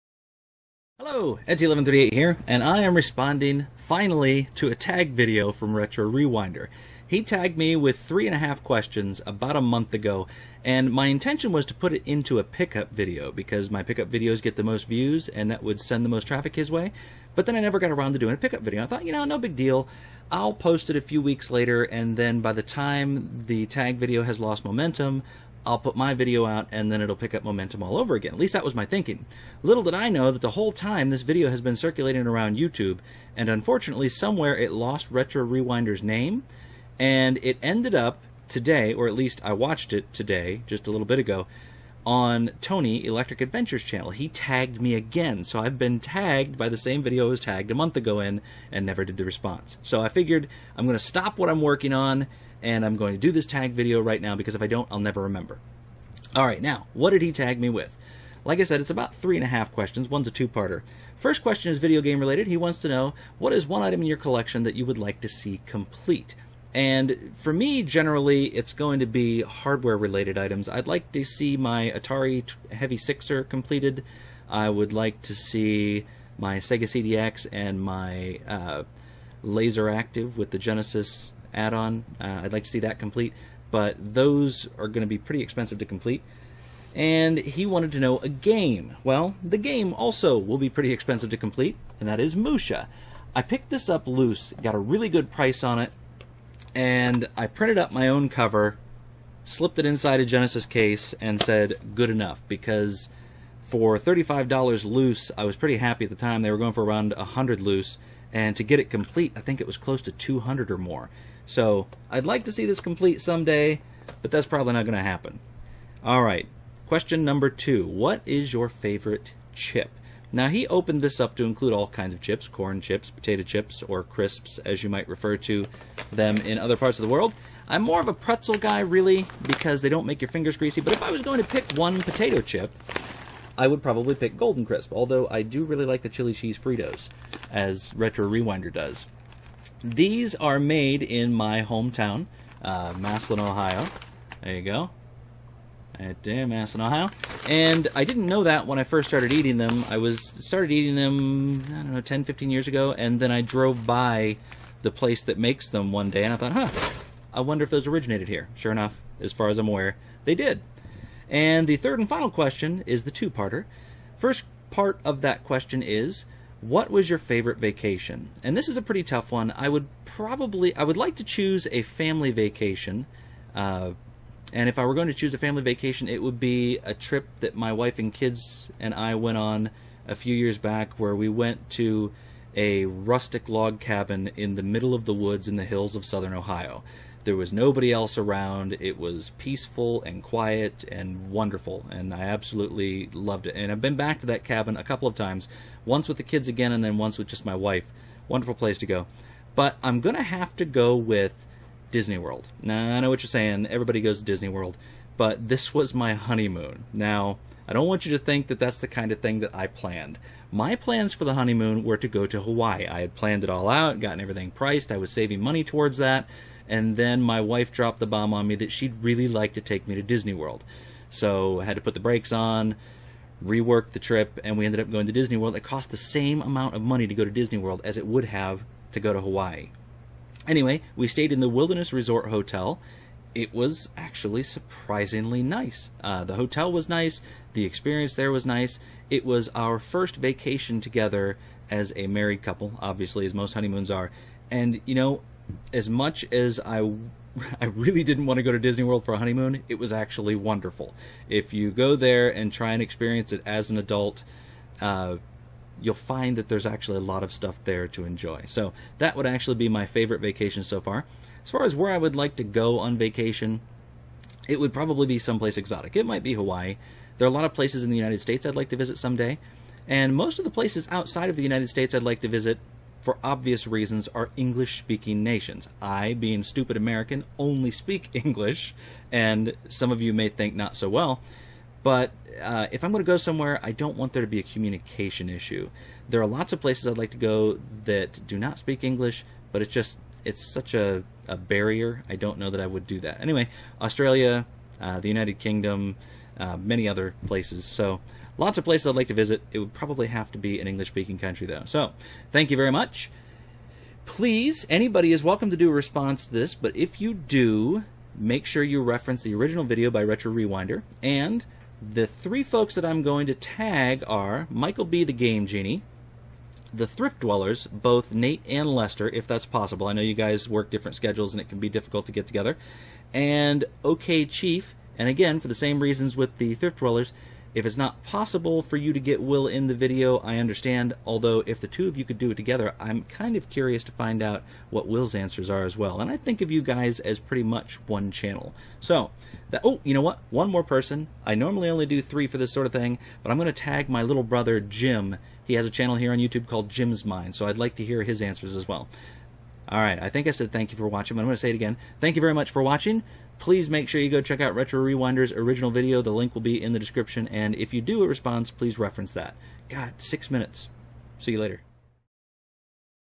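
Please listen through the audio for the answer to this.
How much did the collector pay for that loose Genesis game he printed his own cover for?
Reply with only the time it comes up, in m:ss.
1:43.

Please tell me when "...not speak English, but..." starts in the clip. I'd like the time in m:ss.
4:48.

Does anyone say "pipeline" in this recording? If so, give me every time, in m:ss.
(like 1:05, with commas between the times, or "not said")
not said.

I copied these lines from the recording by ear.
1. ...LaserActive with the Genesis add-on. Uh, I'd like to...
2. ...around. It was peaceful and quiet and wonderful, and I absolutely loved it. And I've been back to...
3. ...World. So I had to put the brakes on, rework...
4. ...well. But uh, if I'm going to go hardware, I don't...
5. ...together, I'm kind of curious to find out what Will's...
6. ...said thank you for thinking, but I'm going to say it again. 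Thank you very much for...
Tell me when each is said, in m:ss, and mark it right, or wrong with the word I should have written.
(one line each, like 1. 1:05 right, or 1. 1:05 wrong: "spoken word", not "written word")
1. 1:19 right
2. 3:08 right
3. 3:40 right
4. 4:40 wrong: "somewhere", not "hardware"
5. 5:32 right
6. 5:50 wrong: "watching", not "thinking".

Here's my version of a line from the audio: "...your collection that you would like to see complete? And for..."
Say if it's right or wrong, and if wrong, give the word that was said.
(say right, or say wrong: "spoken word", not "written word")
right.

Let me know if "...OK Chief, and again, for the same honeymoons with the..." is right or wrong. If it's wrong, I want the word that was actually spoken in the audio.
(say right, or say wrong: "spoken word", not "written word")
wrong: "reasons", not "honeymoons".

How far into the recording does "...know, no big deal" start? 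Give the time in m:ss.
0:19.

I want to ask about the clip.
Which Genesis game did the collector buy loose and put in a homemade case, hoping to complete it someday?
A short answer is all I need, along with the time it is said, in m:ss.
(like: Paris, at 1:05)
Musha, at 1:32.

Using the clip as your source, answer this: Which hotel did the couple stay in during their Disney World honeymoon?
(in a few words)
Wilderness Resort Hotel.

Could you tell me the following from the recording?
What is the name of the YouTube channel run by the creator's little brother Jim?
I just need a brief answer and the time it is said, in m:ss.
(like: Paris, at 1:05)
Jim's Mind, at 5:46.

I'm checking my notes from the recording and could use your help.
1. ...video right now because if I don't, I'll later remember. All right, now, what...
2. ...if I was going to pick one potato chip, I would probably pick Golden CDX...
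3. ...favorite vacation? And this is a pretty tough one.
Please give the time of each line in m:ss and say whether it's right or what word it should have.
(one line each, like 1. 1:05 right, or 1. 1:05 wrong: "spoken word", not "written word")
1. 0:53 wrong: "never", not "later"
2. 2:10 wrong: "Crisp", not "CDX"
3. 2:47 right.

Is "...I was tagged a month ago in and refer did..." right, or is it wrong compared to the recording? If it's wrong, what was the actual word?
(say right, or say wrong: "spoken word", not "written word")
wrong: "never", not "refer".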